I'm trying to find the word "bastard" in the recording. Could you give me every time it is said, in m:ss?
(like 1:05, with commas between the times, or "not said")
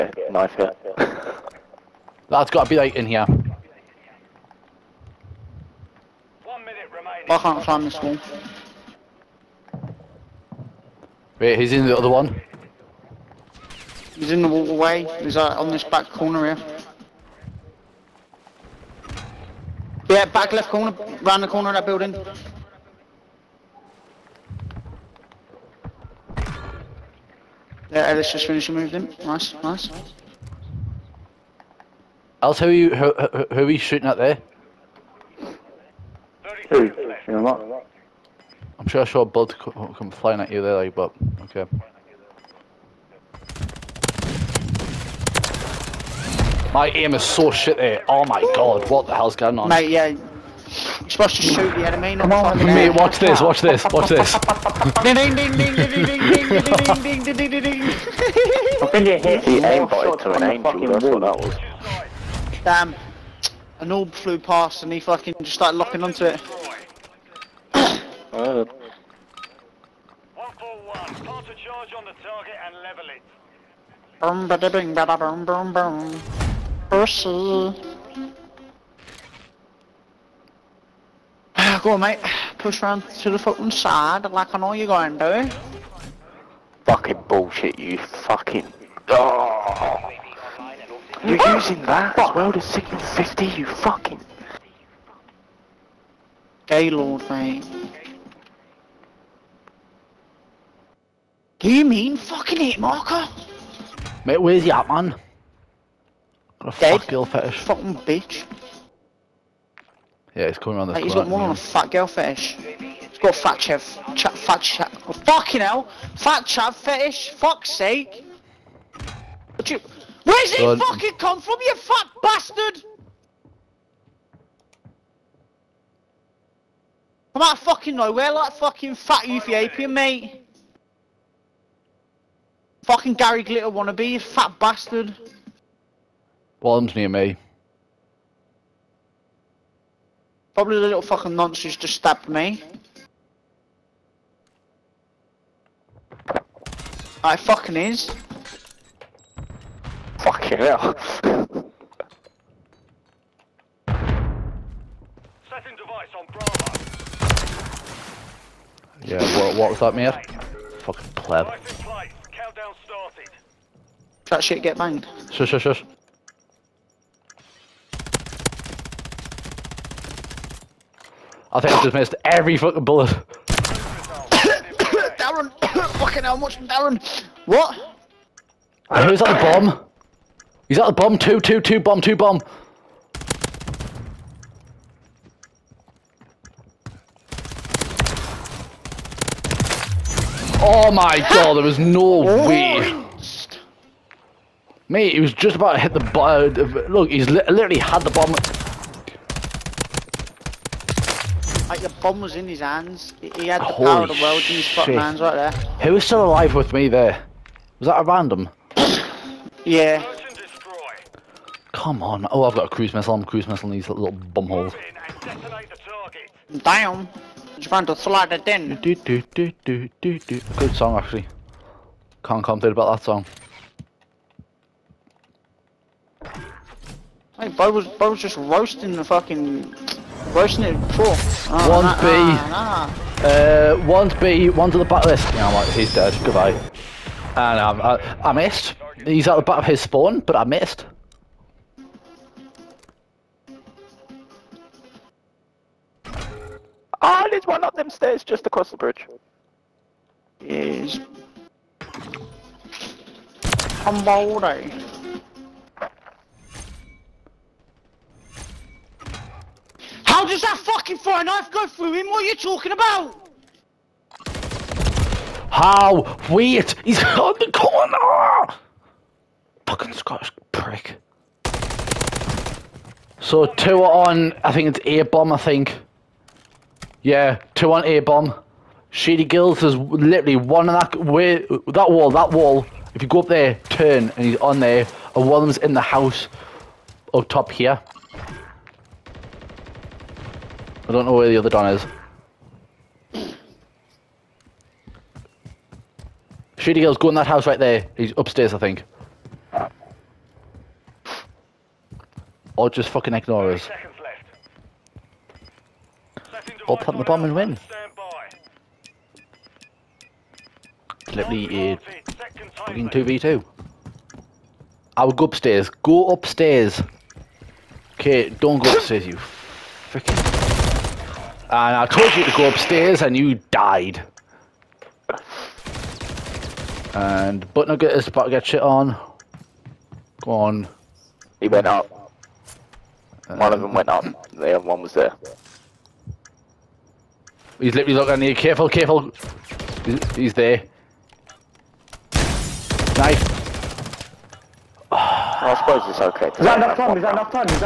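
2:02, 2:14.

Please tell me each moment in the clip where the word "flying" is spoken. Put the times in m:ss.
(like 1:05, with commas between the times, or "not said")
0:40.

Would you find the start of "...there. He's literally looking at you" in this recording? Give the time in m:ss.
5:34.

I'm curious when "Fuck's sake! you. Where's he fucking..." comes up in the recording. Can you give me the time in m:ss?
1:57.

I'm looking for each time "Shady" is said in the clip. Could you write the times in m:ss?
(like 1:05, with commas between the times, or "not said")
4:38, 4:56.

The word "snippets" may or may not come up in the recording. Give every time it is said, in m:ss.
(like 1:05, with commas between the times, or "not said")
not said.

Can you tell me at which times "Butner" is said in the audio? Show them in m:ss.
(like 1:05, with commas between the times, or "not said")
5:27.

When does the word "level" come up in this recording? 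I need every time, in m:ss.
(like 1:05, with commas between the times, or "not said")
1:12.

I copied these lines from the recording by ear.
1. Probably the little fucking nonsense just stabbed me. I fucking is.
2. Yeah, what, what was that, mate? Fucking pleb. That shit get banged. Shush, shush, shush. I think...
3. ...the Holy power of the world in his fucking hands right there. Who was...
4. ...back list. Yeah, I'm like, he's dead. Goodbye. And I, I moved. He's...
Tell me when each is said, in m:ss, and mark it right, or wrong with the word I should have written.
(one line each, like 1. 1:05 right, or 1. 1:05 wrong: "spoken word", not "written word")
1. 2:20 right
2. 2:39 right
3. 3:23 right
4. 3:54 wrong: "missed", not "moved".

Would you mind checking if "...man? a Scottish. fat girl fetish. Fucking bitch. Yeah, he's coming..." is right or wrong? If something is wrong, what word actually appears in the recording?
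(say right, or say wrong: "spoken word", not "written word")
wrong: "Dead", not "Scottish".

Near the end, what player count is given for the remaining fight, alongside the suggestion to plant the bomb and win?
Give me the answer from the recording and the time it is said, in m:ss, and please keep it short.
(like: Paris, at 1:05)
2v2, at 5:12.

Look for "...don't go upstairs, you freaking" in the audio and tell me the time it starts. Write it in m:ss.
5:18.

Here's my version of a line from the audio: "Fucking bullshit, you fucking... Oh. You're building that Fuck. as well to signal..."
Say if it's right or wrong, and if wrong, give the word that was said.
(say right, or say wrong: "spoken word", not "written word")
wrong: "using", not "building".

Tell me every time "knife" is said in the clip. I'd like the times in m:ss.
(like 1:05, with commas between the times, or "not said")
0:00, 4:21.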